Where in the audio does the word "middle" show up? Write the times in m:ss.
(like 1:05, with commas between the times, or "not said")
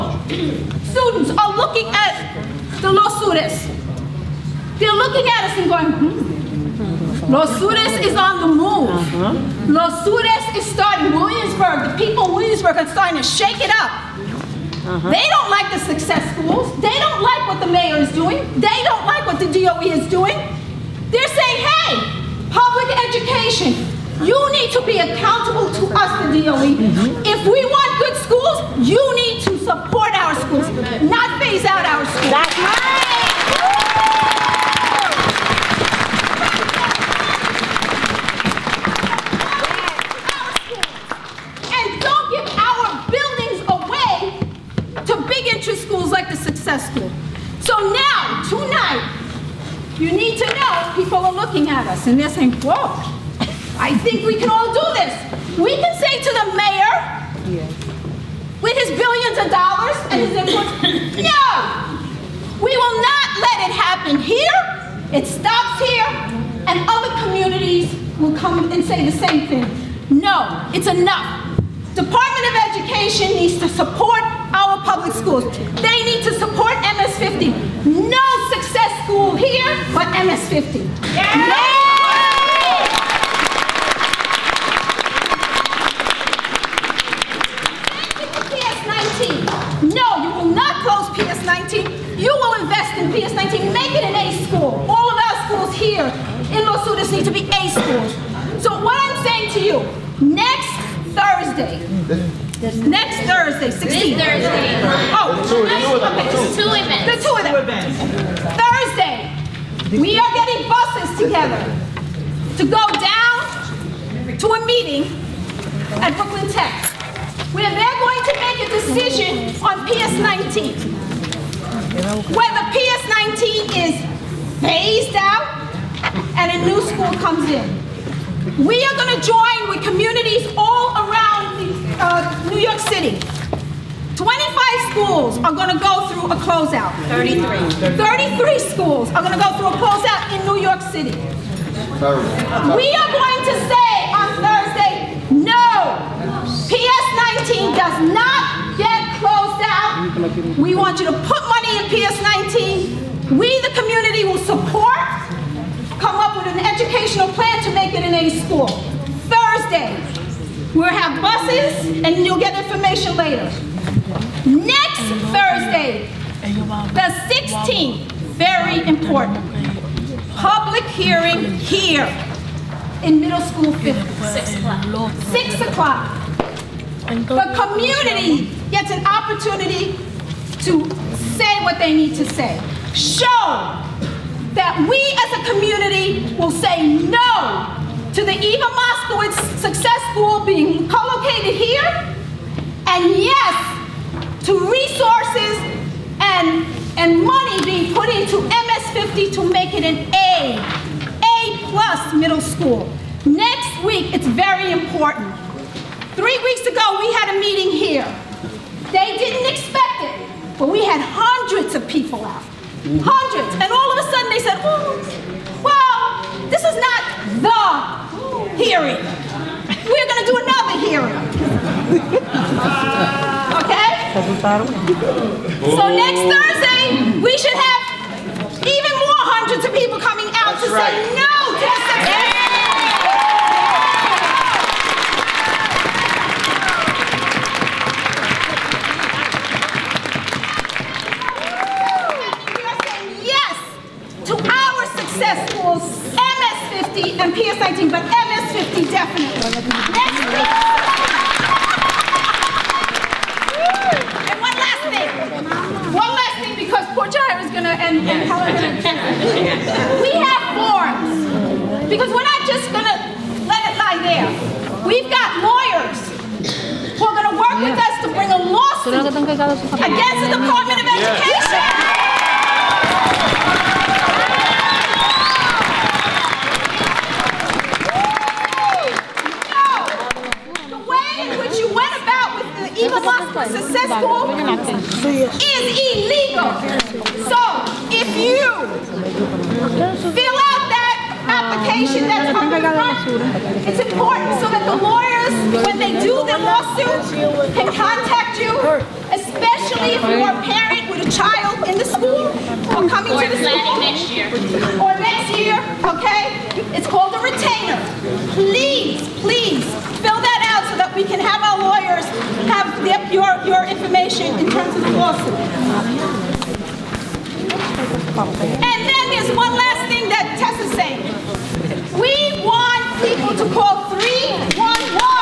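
2:53, 3:22.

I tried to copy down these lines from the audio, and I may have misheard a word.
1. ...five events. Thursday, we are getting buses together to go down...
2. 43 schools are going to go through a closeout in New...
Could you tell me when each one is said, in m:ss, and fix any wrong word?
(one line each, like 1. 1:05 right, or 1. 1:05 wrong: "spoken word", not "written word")
1. 1:47 wrong: "two", not "five"
2. 2:17 wrong: "33", not "43".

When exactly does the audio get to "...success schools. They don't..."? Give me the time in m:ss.
0:15.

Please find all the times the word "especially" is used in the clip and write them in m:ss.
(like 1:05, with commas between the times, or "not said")
4:59.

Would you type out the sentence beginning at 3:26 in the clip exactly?
Three weeks ago, we had a meeting here.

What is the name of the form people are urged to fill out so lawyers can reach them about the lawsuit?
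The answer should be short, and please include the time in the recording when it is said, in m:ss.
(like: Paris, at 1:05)
retainer, at 5:07.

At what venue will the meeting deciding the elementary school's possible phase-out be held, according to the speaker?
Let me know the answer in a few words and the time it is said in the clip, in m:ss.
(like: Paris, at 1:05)
Brooklyn Tech, at 1:56.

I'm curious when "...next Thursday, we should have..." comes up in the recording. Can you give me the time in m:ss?
3:45.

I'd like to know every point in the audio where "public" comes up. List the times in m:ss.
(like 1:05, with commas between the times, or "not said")
0:22, 1:14, 2:50.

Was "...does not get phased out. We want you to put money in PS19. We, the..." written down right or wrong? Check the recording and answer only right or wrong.
wrong.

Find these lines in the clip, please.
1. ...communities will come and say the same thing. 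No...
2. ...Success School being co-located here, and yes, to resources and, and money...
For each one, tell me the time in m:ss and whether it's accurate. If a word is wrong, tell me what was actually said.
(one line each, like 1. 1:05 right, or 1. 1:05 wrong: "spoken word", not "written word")
1. 1:07 right
2. 3:09 right.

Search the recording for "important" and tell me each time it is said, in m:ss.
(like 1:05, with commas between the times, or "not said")
2:48, 3:24, 4:53.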